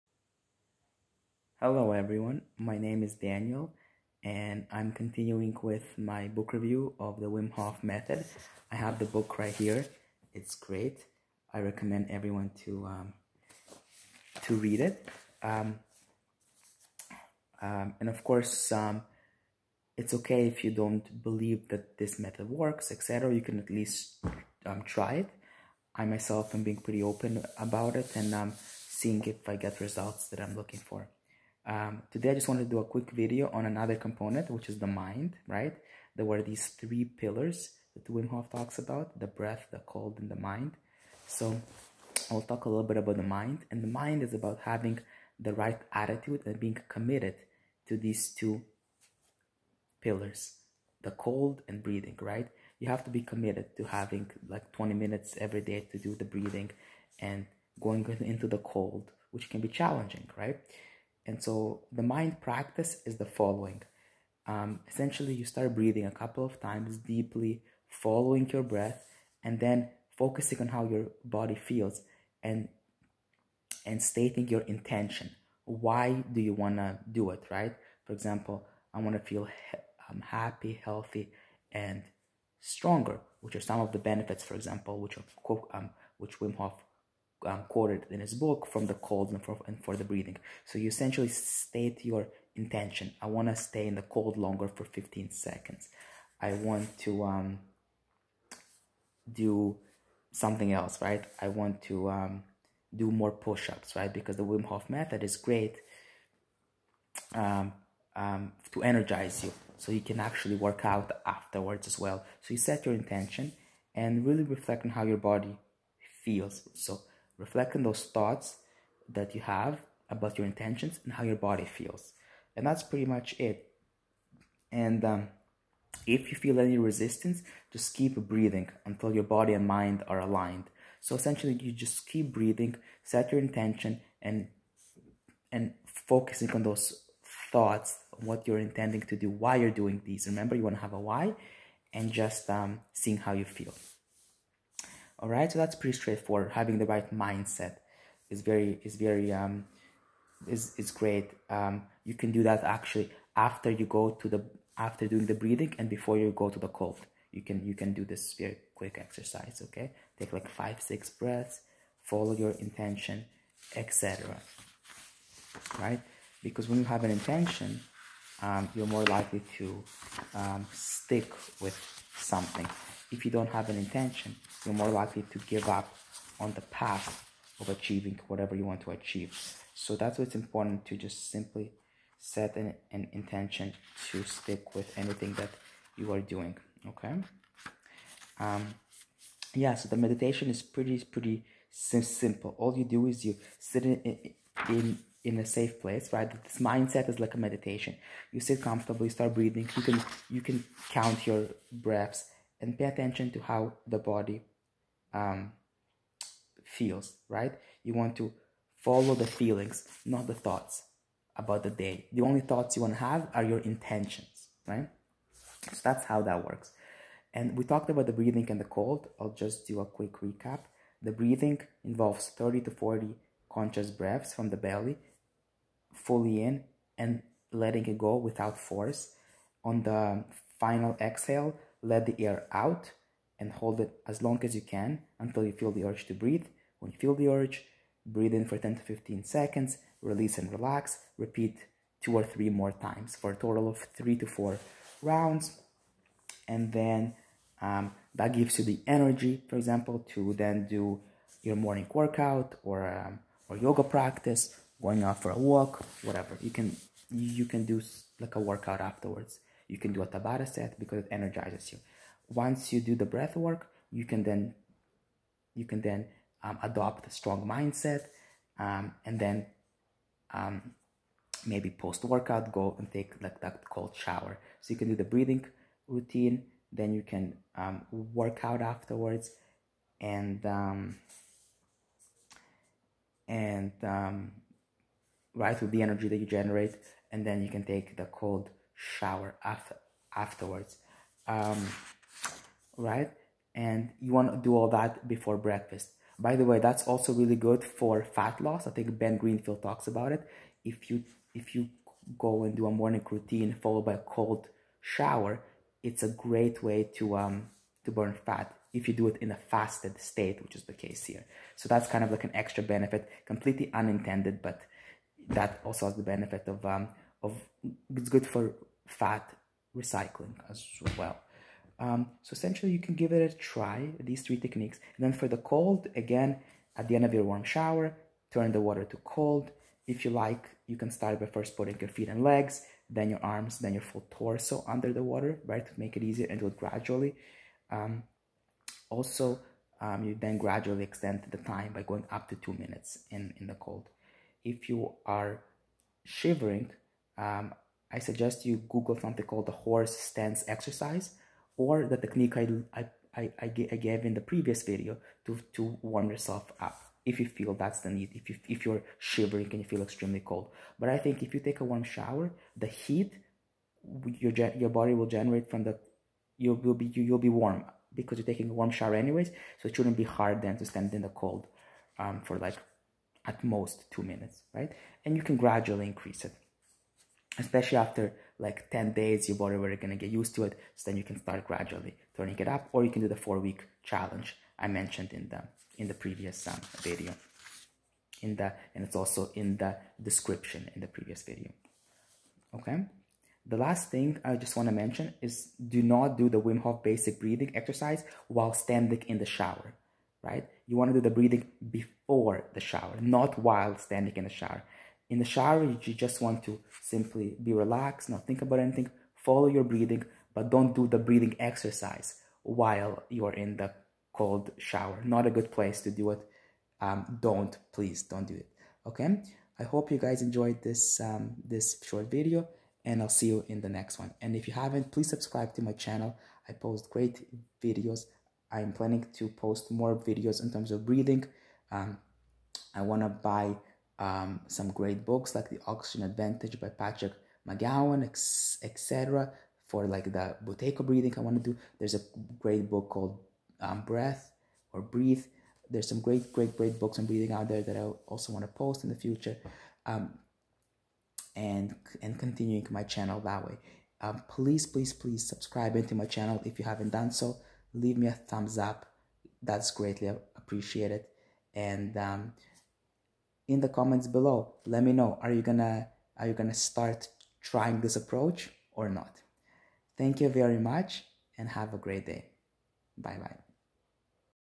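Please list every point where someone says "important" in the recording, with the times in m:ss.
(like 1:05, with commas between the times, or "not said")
3:00.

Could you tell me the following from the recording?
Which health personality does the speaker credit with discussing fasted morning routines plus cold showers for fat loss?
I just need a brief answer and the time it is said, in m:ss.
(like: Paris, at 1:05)
Ben Greenfield, at 4:58.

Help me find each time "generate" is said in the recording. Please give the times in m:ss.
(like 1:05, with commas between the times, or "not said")
4:46, 6:05.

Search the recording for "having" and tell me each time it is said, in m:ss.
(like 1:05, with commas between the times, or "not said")
0:44, 0:53, 2:26.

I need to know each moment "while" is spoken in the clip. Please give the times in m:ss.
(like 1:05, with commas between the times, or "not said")
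6:38, 6:43, 6:52.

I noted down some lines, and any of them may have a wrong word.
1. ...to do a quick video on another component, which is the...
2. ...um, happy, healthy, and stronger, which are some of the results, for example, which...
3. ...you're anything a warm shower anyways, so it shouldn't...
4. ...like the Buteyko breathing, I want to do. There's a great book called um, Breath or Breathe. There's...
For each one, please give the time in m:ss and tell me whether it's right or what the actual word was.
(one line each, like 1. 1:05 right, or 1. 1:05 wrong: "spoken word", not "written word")
1. 0:32 right
2. 1:20 wrong: "benefits", not "results"
3. 6:08 wrong: "taking", not "anything"
4. 7:19 right.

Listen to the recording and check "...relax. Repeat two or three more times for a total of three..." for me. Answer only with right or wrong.
right.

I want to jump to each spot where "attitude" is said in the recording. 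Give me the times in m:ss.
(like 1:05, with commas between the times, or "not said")
0:45.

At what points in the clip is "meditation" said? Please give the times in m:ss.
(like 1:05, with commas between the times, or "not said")
3:09, 3:17.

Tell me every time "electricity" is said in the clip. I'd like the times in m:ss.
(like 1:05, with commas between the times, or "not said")
not said.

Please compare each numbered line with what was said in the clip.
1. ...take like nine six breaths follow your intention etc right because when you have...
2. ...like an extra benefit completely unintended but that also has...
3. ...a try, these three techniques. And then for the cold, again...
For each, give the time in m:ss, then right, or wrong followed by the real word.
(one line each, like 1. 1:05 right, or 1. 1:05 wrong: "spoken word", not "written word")
1. 2:40 wrong: "five", not "nine"
2. 5:12 right
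3. 5:23 right.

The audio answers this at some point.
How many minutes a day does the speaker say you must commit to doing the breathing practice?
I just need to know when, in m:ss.
0:54.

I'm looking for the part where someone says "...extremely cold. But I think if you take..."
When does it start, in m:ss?
5:59.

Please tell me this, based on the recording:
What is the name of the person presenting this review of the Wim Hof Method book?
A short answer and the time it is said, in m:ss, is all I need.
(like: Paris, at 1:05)
Daniel, at 0:03.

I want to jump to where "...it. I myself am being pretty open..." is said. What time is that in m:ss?
0:25.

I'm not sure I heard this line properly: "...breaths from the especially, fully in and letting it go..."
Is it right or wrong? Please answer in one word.
wrong.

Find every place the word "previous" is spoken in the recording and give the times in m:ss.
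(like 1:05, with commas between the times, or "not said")
5:54, 6:25, 6:30.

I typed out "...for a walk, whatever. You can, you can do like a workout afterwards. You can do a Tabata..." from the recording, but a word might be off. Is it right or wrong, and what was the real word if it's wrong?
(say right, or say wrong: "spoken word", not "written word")
right.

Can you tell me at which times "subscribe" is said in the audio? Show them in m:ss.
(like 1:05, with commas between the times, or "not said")
7:05, 7:35.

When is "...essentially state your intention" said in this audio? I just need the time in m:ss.
1:30.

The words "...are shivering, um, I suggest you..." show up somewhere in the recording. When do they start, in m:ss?
5:45.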